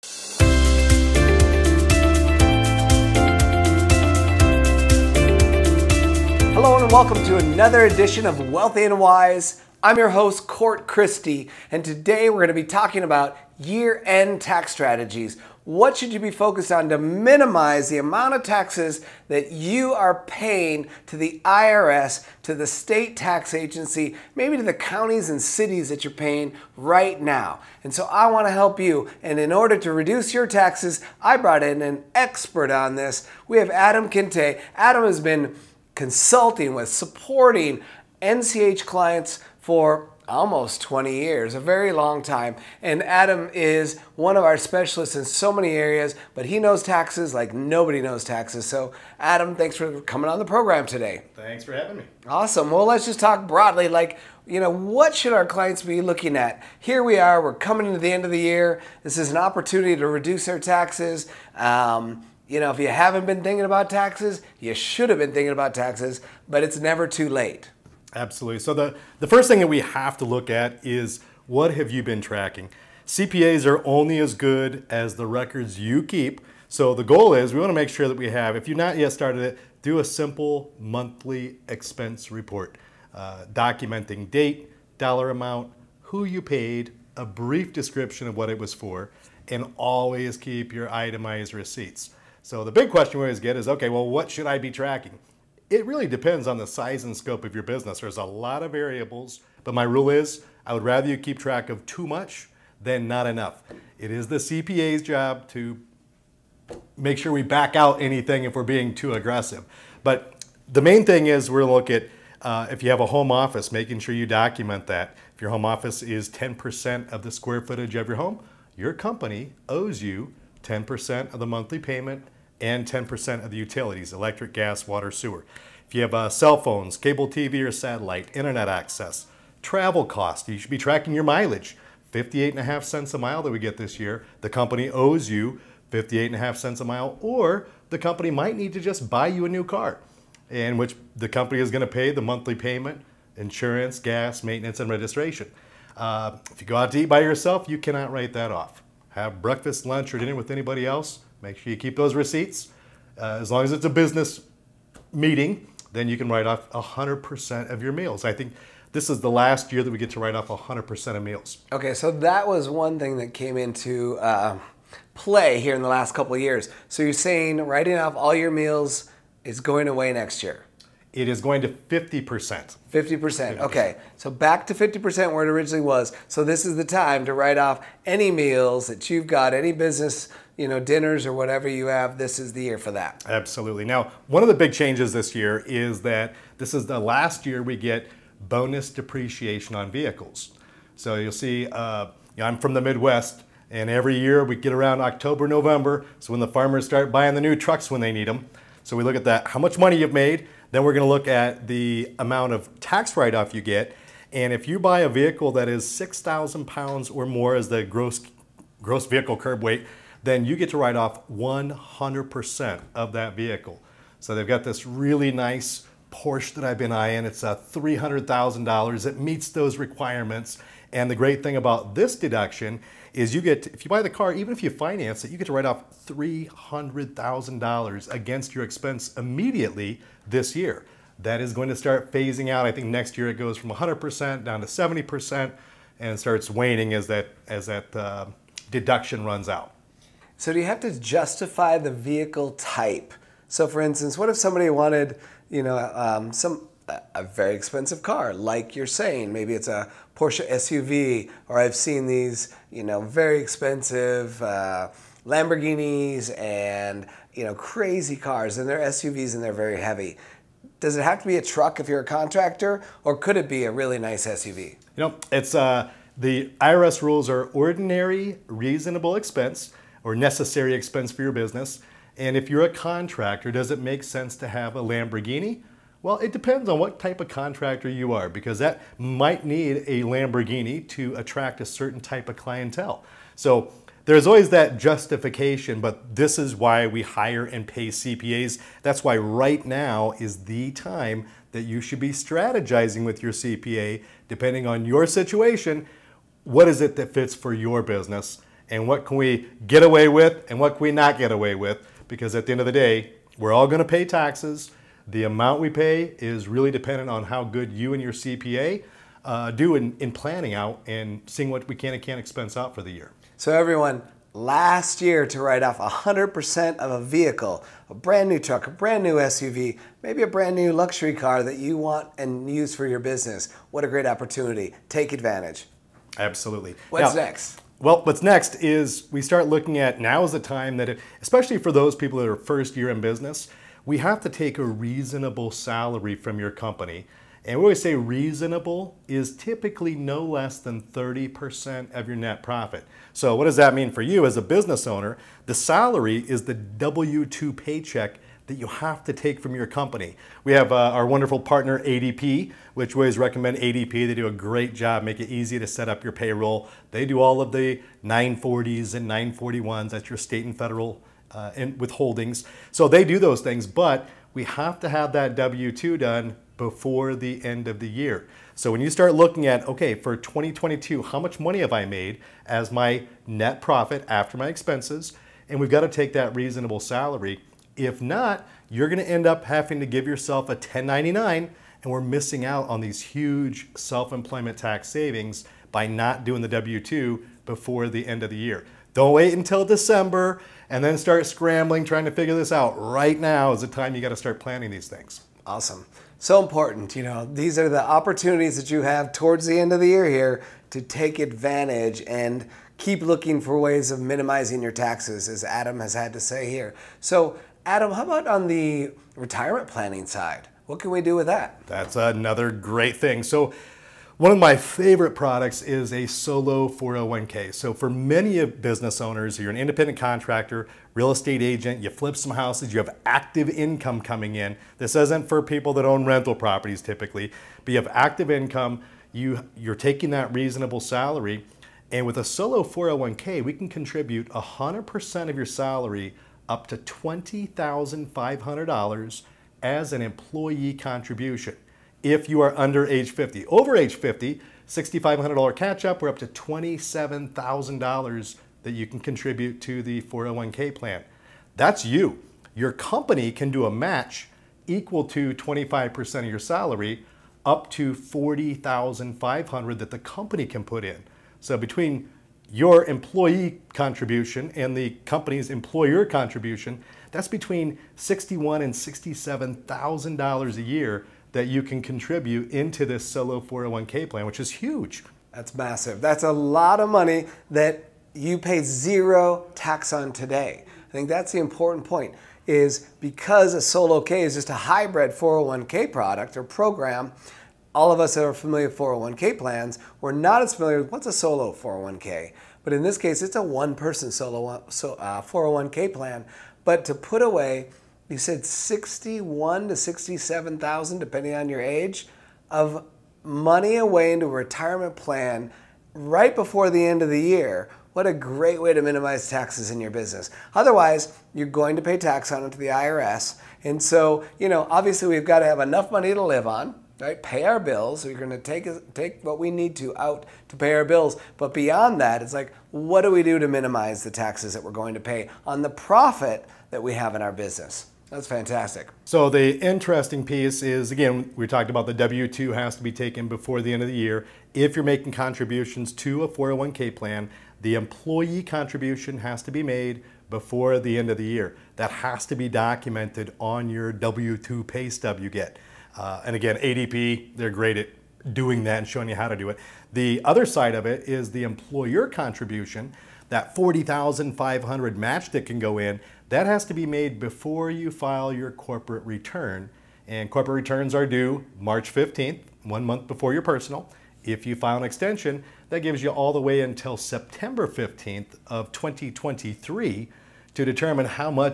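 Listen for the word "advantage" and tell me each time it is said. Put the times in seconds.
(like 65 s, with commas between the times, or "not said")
325 s, 401 s.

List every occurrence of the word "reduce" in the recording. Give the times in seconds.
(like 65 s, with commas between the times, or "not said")
29 s, 60 s.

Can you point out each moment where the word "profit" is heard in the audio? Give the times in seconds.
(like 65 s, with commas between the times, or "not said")
342 s, 373 s, 525 s.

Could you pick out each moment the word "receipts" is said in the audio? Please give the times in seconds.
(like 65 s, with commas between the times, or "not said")
91 s, 152 s.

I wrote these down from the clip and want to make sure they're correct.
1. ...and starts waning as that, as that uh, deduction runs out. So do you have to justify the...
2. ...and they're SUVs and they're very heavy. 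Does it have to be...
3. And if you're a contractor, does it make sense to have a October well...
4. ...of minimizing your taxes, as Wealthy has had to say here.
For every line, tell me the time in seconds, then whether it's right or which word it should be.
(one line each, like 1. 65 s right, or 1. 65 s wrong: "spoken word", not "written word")
1. 235 s right
2. 258 s right
3. 272 s wrong: "Lamborghini", not "October"
4. 403 s wrong: "Adam", not "Wealthy".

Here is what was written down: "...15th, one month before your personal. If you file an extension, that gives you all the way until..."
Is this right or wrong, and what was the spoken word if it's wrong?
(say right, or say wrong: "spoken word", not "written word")
right.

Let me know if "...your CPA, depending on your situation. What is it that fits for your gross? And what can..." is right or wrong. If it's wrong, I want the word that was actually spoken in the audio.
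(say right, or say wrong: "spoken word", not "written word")
wrong: "business", not "gross".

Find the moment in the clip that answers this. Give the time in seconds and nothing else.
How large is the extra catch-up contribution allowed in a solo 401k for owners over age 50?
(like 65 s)
444 s.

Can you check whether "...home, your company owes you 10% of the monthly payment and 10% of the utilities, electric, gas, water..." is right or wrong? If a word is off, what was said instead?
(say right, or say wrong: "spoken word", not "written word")
right.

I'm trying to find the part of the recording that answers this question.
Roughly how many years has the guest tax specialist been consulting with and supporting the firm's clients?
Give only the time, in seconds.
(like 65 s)
40 s.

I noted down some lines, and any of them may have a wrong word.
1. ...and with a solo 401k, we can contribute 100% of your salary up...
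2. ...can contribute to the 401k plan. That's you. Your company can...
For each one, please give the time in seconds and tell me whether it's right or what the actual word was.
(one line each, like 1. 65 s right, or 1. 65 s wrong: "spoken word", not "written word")
1. 431 s right
2. 448 s right.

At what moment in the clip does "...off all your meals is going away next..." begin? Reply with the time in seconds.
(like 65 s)
167 s.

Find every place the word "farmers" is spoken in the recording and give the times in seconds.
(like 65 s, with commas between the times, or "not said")
196 s.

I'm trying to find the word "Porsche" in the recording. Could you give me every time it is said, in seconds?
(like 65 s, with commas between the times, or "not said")
216 s, 250 s.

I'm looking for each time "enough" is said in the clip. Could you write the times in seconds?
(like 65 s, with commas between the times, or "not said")
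103 s, 515 s.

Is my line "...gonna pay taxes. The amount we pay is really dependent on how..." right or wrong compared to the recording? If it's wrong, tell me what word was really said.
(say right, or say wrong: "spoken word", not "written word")
right.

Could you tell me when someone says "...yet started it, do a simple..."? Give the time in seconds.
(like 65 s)
78 s.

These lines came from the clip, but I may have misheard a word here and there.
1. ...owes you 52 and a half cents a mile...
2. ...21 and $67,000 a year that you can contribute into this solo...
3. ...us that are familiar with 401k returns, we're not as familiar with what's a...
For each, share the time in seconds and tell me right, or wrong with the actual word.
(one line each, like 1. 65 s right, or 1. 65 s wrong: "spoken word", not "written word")
1. 134 s wrong: "58", not "52"
2. 467 s wrong: "61", not "21"
3. 487 s wrong: "plans", not "returns".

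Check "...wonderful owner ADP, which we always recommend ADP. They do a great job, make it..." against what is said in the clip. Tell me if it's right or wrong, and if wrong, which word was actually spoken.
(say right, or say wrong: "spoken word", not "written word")
wrong: "partner", not "owner".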